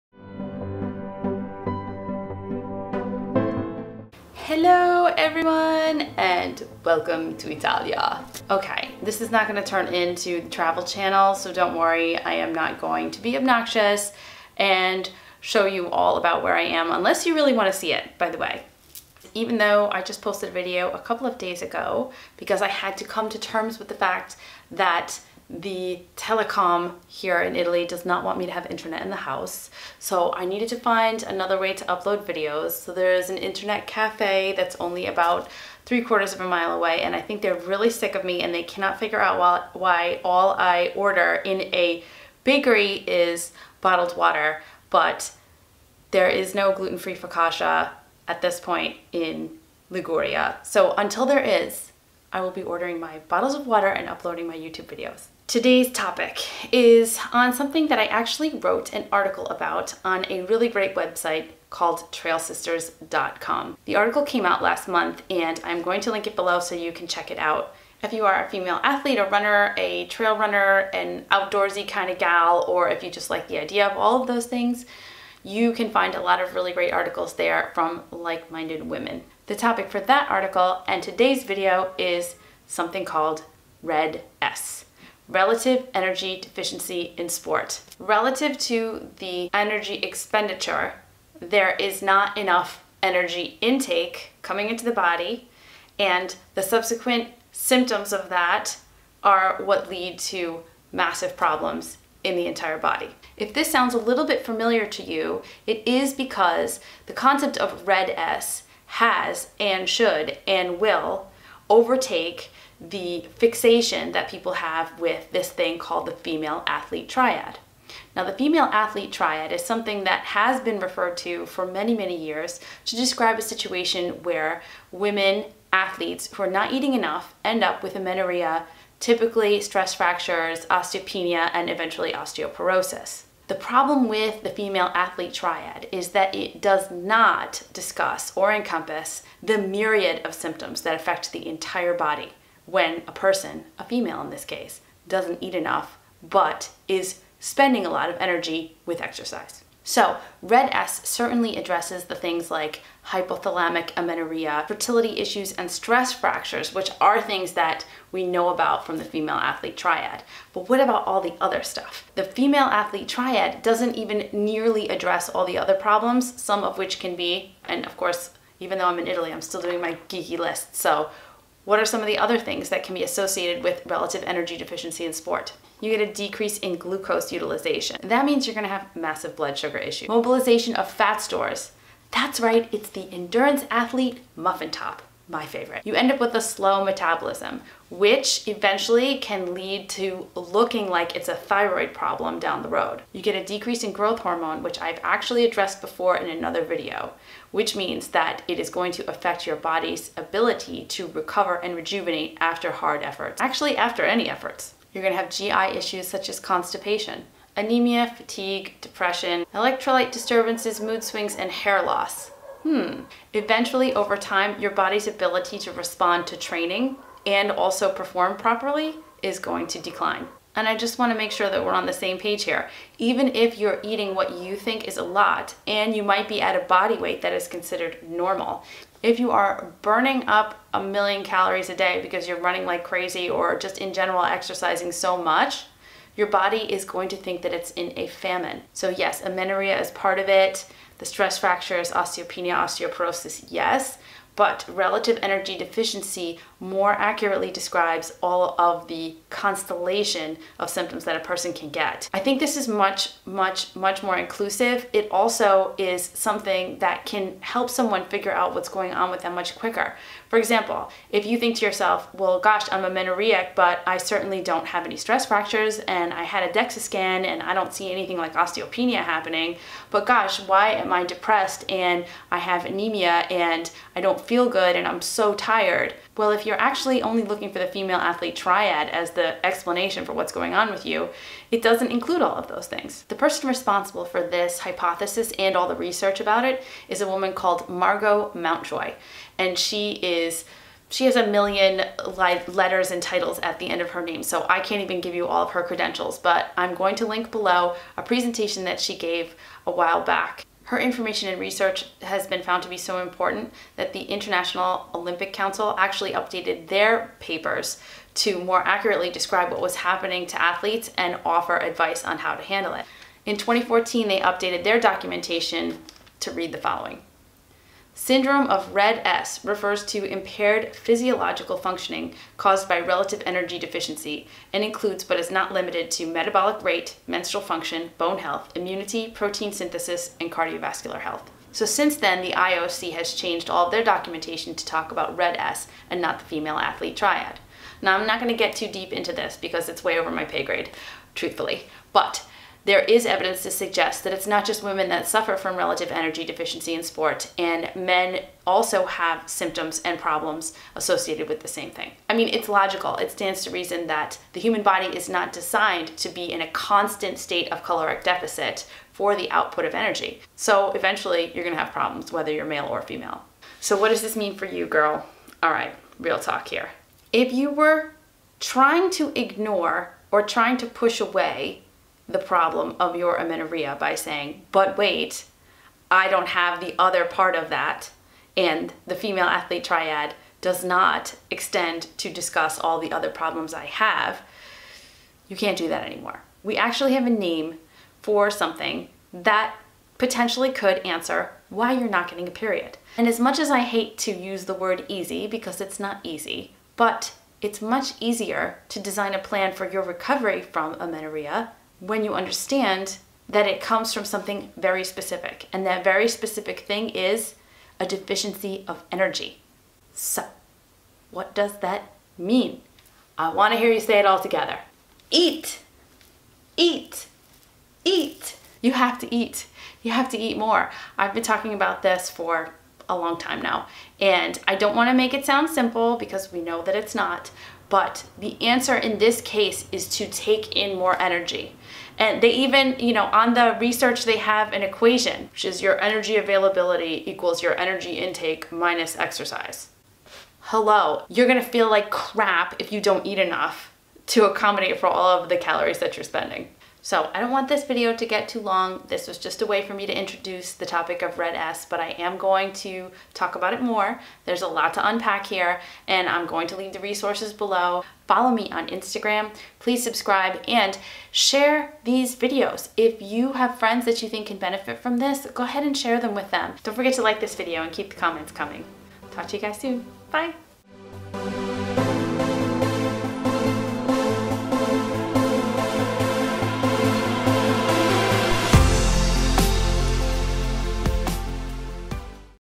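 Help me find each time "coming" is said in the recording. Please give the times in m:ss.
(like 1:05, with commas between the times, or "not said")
1:34, 7:48.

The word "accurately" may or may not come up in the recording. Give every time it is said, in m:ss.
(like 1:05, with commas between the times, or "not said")
4:06, 5:08.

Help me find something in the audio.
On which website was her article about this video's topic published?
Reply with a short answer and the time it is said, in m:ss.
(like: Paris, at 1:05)
trailsisters.com, at 1:02.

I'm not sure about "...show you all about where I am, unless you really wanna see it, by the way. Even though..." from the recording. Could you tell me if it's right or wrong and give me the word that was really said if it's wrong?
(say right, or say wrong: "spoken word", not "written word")
right.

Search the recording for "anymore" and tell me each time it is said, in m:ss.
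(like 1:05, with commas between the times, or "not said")
6:25.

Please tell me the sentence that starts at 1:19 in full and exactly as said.
The topic for that article and today's video is something called Red S relative energy deficiency in sport.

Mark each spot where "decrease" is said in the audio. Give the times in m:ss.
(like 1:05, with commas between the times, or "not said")
2:56, 3:13.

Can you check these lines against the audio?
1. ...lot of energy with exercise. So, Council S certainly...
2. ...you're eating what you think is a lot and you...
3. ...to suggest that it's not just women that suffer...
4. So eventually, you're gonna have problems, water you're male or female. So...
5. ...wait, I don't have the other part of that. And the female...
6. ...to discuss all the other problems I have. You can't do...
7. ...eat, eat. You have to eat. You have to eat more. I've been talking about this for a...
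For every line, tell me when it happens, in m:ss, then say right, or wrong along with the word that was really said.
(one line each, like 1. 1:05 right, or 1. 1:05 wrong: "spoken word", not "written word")
1. 2:27 wrong: "Red", not "Council"
2. 3:43 right
3. 5:43 right
4. 6:00 wrong: "whether", not "water"
5. 6:14 right
6. 6:21 right
7. 6:56 right.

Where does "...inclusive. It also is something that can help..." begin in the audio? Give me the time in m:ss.
4:14.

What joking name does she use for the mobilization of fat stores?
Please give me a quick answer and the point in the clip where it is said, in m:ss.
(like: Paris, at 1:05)
endurance athlete muffin top, at 3:03.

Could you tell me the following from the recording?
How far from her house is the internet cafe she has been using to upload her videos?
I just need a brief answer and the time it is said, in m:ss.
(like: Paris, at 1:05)
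3/4 of a mile, at 0:35.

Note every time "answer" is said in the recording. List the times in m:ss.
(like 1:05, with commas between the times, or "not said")
6:30, 7:08.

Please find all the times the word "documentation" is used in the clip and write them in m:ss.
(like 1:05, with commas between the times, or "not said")
5:14, 5:33.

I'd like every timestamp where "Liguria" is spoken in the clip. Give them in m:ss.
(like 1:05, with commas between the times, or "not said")
0:49.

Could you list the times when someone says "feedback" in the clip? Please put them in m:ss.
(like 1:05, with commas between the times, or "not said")
not said.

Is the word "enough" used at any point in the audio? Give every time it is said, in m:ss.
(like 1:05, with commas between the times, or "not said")
1:32, 2:06, 2:25, 7:23.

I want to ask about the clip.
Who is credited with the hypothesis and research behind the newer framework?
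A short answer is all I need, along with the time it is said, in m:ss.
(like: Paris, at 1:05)
Margo Mountjoy, at 4:47.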